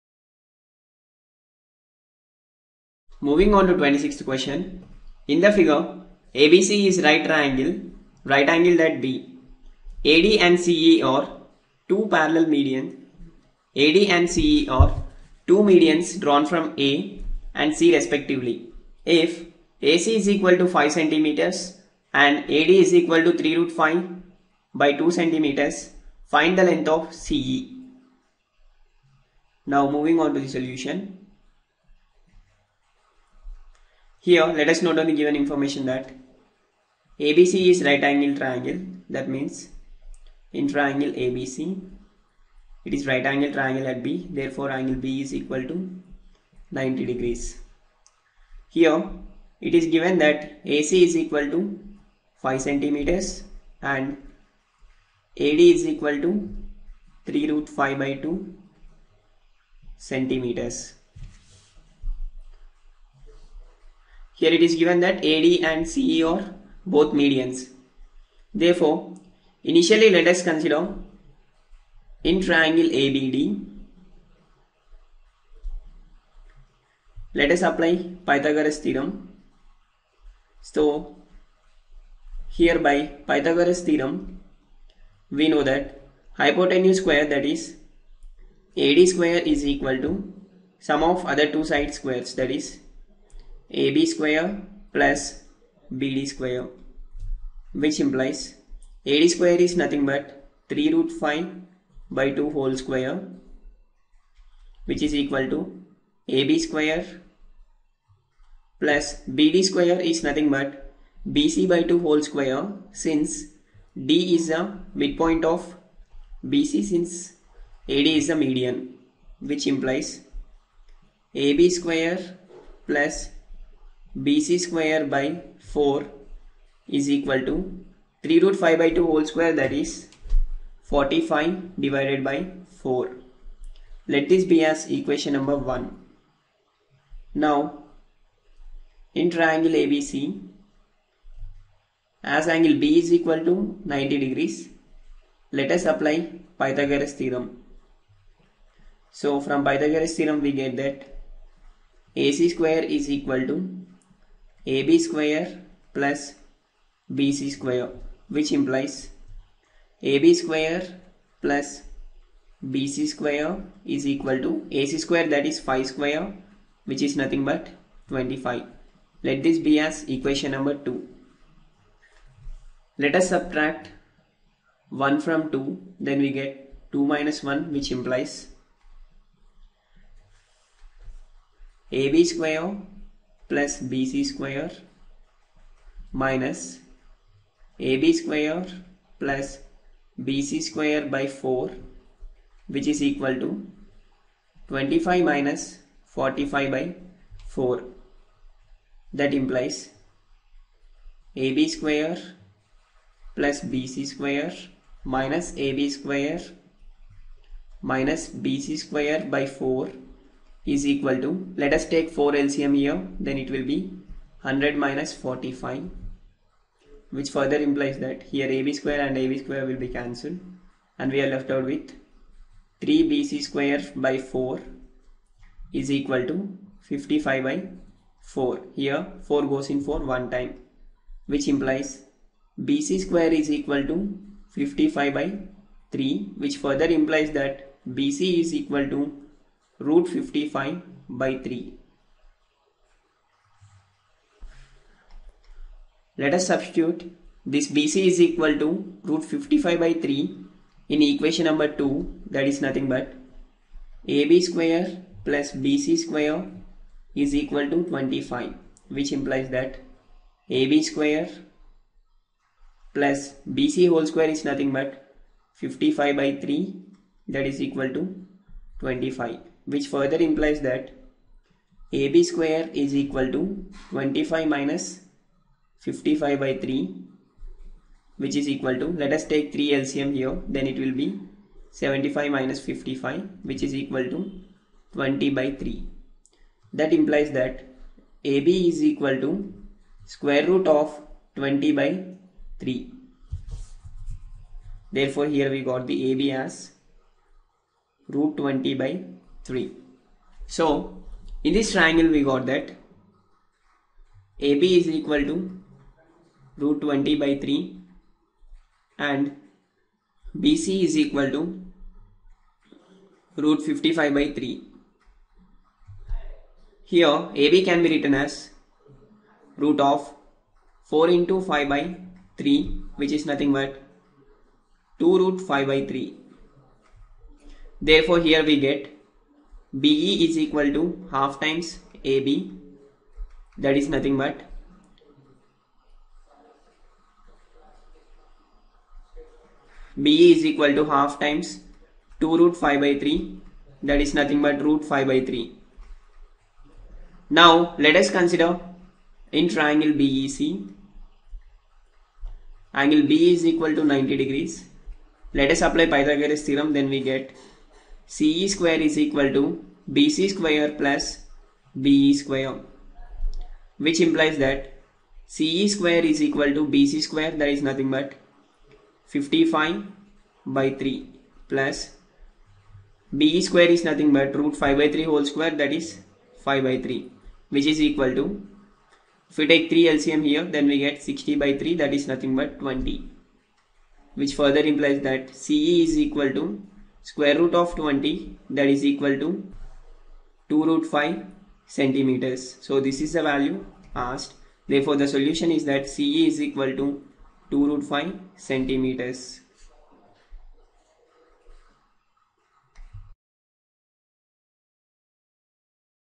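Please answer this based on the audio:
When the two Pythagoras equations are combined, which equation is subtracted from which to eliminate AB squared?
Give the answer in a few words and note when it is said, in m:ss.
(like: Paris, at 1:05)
1 from 2, at 2:53.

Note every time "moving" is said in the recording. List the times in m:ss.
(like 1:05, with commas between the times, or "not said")
0:03, 0:29.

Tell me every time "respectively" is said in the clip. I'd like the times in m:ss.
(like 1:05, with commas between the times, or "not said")
0:17.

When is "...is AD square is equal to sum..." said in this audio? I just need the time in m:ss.
1:27.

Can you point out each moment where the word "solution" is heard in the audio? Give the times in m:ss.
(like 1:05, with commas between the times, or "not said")
0:30, 6:35.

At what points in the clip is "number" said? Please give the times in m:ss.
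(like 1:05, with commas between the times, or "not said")
2:15, 2:50, 4:11.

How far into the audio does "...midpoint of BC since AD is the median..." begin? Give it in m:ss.
1:54.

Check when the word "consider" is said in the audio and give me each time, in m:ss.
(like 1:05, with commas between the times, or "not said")
1:10, 5:48.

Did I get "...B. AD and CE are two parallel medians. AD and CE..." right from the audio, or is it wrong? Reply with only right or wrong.
right.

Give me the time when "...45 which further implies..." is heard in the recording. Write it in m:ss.
3:35.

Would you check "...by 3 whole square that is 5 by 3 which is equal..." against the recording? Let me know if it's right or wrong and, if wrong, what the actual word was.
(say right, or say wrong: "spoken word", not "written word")
right.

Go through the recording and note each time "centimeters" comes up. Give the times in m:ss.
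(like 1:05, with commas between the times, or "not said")
0:20, 0:25, 0:52, 0:59, 6:31, 6:38.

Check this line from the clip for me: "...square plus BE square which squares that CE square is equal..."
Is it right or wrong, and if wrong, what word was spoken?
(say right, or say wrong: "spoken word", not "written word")
wrong: "implies", not "squares".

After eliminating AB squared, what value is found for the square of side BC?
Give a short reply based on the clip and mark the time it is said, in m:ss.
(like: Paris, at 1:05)
55/3, at 3:52.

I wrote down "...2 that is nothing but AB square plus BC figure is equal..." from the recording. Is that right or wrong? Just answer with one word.
wrong.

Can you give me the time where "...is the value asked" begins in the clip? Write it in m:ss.
6:33.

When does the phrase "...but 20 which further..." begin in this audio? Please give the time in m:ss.
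6:22.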